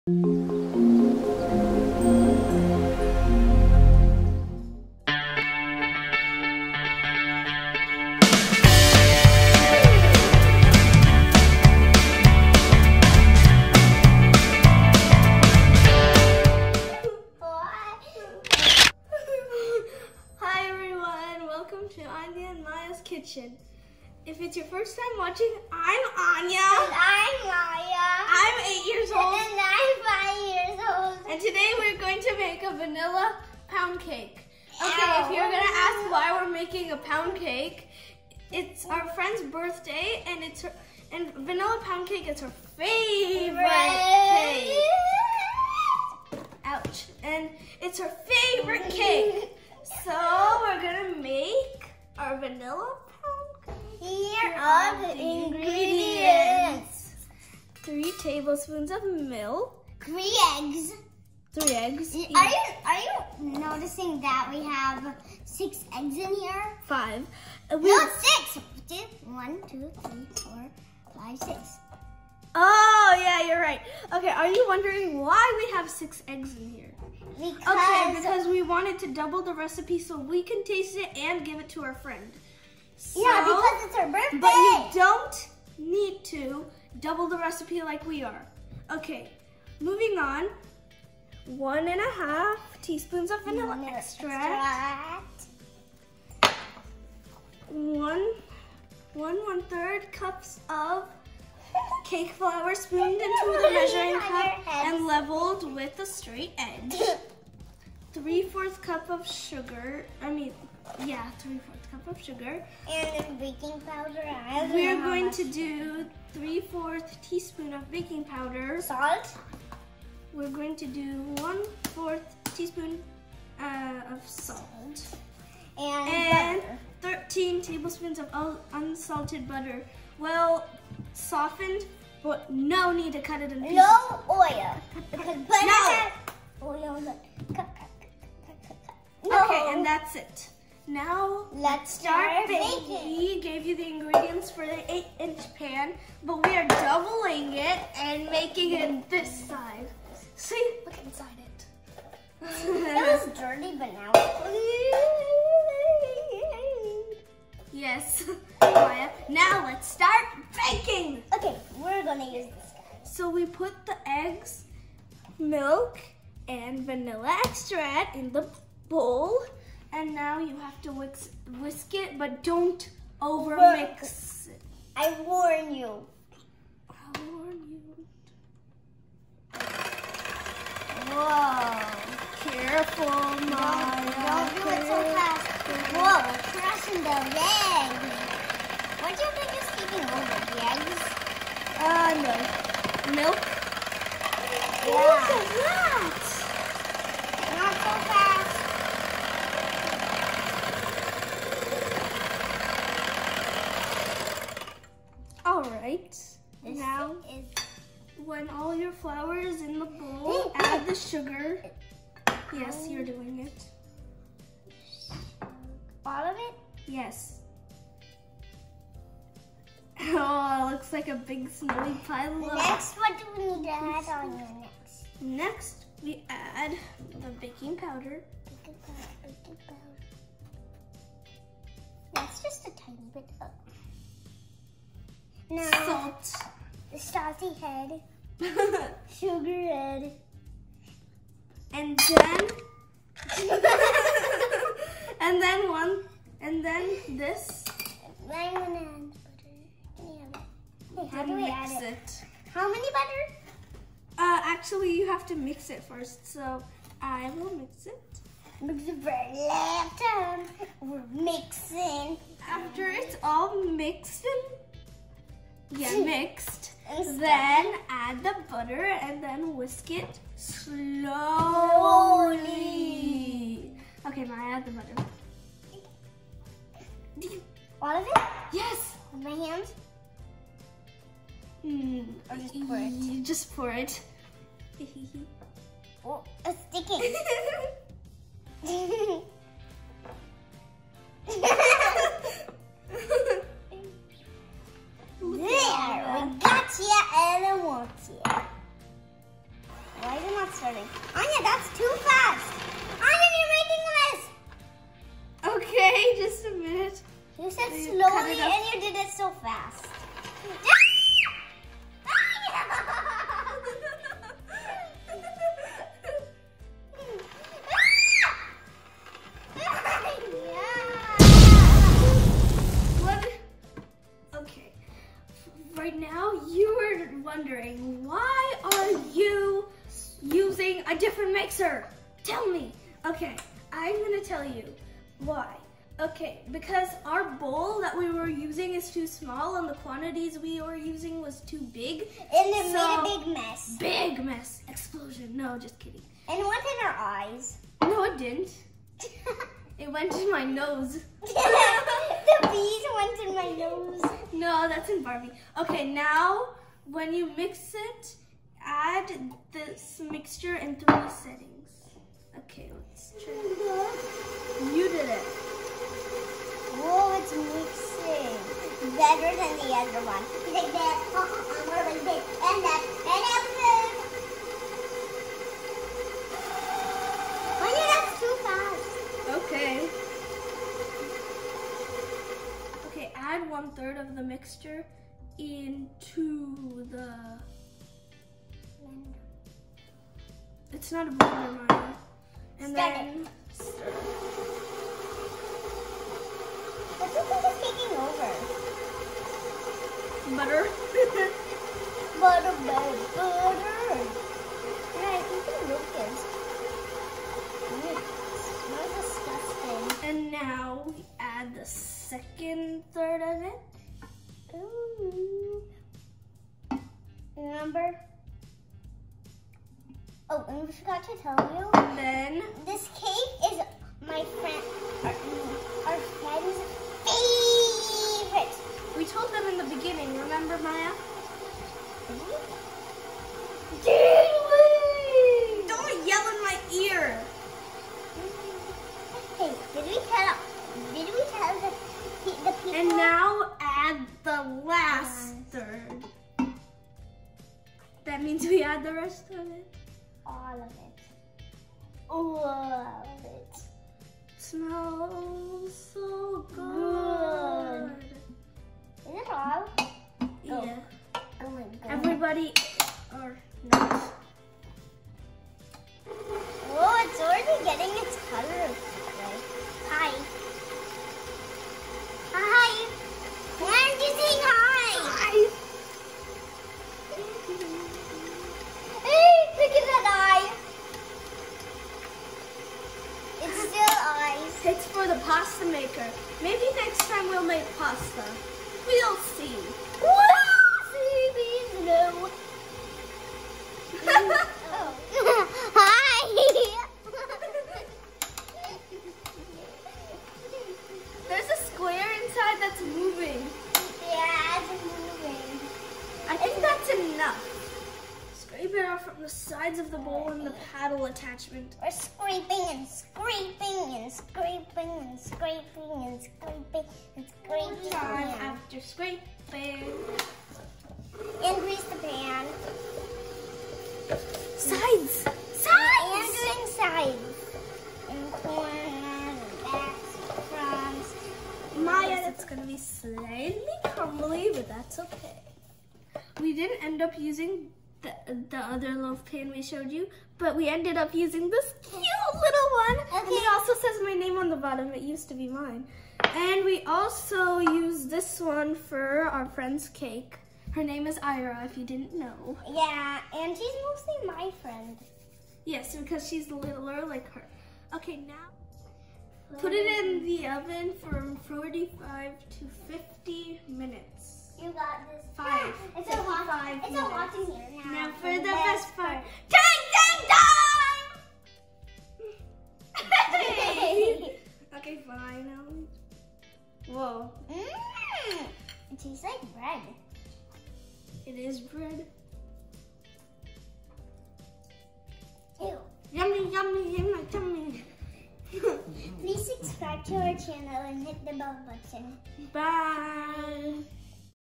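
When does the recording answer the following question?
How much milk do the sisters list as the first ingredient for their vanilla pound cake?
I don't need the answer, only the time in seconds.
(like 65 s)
57 s.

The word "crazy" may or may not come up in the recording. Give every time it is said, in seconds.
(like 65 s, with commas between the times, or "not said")
not said.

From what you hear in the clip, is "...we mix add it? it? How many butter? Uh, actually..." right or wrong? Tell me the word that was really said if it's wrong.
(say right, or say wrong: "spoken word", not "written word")
right.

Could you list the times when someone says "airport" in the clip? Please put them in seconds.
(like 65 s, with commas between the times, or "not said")
not said.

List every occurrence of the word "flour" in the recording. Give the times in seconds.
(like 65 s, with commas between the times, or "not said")
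102 s, 208 s.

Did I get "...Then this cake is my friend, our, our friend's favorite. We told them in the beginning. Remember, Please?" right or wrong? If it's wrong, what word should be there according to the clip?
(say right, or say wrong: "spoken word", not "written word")
wrong: "Maaya", not "Please".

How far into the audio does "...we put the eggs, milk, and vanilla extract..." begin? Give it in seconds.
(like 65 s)
163 s.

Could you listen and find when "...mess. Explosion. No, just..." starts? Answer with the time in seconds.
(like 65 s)
344 s.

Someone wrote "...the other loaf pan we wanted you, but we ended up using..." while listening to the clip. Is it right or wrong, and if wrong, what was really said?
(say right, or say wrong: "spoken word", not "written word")
wrong: "showed", not "wanted".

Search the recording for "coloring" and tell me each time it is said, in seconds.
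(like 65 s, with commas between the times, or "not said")
not said.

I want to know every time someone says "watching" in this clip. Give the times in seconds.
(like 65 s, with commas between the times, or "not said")
25 s.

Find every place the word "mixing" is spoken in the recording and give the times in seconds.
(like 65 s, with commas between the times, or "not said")
261 s, 367 s.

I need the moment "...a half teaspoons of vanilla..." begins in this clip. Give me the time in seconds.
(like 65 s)
91 s.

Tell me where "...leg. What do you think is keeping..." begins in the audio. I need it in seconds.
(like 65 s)
187 s.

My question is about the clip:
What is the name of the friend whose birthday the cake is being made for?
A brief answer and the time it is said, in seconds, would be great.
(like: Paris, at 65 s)
Ira, at 551 s.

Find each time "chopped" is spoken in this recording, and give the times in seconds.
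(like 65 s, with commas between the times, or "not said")
not said.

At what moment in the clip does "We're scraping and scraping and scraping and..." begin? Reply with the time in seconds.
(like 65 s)
511 s.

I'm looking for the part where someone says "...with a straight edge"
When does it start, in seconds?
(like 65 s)
105 s.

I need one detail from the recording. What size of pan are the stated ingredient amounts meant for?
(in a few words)
8-inch.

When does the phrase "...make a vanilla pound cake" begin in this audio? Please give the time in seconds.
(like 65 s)
32 s.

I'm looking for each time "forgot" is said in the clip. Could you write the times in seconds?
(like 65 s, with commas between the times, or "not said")
420 s.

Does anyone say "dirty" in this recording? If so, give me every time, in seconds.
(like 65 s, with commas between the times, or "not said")
153 s.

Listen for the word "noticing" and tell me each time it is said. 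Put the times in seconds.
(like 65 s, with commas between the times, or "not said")
63 s.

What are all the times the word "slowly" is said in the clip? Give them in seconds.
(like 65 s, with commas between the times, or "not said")
270 s, 307 s.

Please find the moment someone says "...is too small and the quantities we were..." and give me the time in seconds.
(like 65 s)
338 s.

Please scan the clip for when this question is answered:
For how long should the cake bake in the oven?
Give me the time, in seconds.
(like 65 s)
561 s.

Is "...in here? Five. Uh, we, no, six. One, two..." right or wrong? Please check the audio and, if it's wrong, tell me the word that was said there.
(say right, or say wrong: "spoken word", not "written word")
right.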